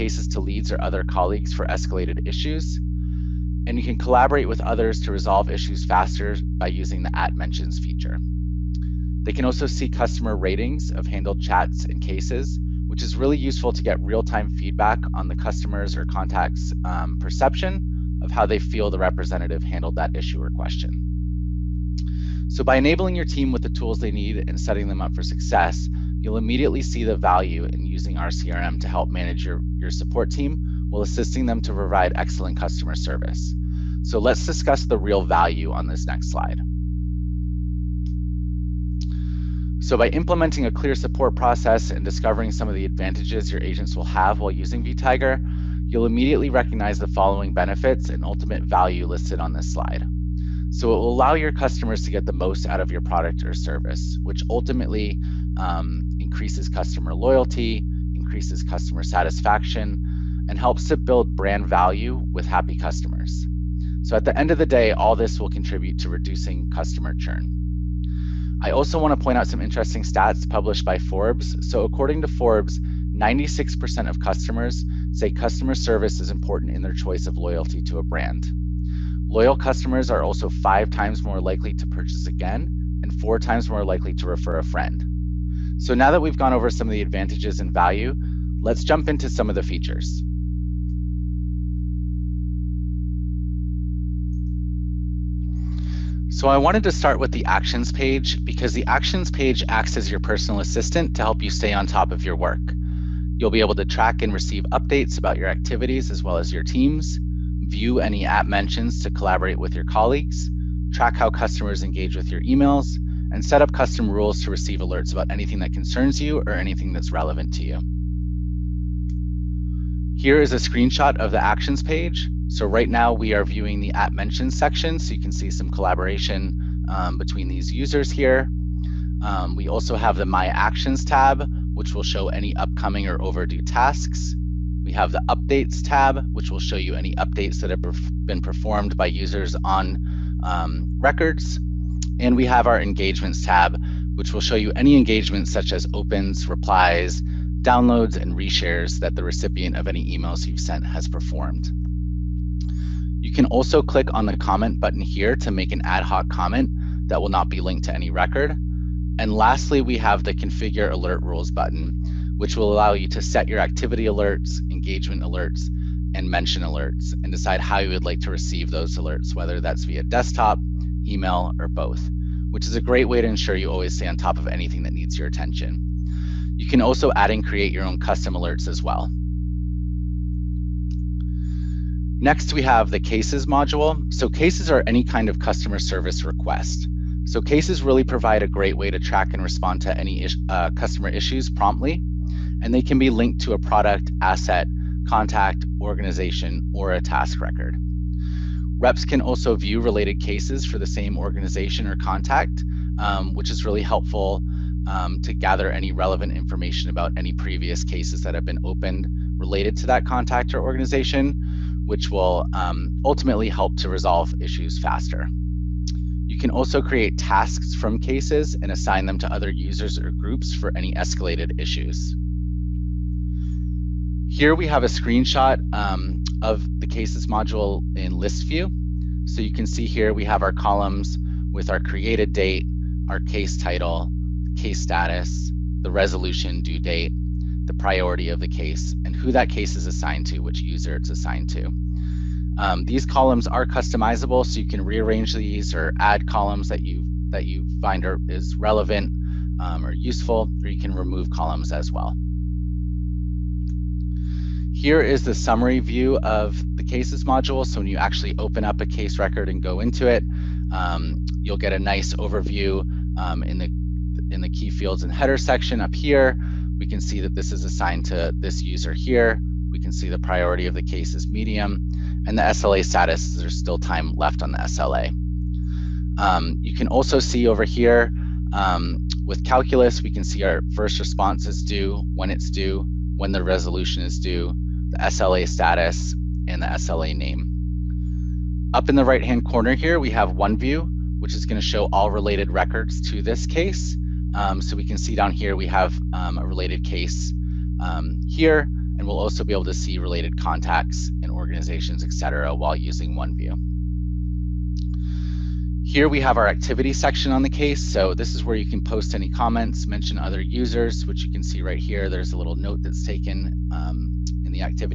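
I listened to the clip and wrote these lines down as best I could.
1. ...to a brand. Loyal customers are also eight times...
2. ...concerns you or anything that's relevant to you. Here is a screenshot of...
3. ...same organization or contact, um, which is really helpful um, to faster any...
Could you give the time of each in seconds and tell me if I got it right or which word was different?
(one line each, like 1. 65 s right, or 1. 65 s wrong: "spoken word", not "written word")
1. 77 s wrong: "five", not "eight"
2. 115 s right
3. 200 s wrong: "gather", not "faster".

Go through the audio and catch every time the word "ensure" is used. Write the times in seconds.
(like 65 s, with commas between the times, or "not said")
173 s.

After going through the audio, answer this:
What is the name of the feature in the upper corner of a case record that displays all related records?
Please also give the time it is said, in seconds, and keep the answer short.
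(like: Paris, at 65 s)
OneView, at 290 s.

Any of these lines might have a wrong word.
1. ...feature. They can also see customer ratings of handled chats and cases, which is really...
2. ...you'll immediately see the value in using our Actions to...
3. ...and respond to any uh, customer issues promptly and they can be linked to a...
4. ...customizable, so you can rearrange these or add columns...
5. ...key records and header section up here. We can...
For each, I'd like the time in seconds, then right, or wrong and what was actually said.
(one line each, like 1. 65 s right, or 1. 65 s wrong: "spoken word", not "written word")
1. 7 s right
2. 26 s wrong: "CRM", not "Actions"
3. 189 s right
4. 243 s right
5. 264 s wrong: "fields", not "records".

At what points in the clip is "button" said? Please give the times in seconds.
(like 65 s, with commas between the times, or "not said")
154 s, 161 s.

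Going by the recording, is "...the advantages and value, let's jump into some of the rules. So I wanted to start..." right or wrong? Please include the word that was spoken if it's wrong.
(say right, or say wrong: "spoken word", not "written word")
wrong: "features", not "rules".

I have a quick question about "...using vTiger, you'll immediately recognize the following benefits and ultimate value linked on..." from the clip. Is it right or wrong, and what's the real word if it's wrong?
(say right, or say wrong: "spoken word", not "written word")
wrong: "listed", not "linked".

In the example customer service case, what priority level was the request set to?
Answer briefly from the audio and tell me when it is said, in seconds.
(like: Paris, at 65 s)
Medium, at 271 s.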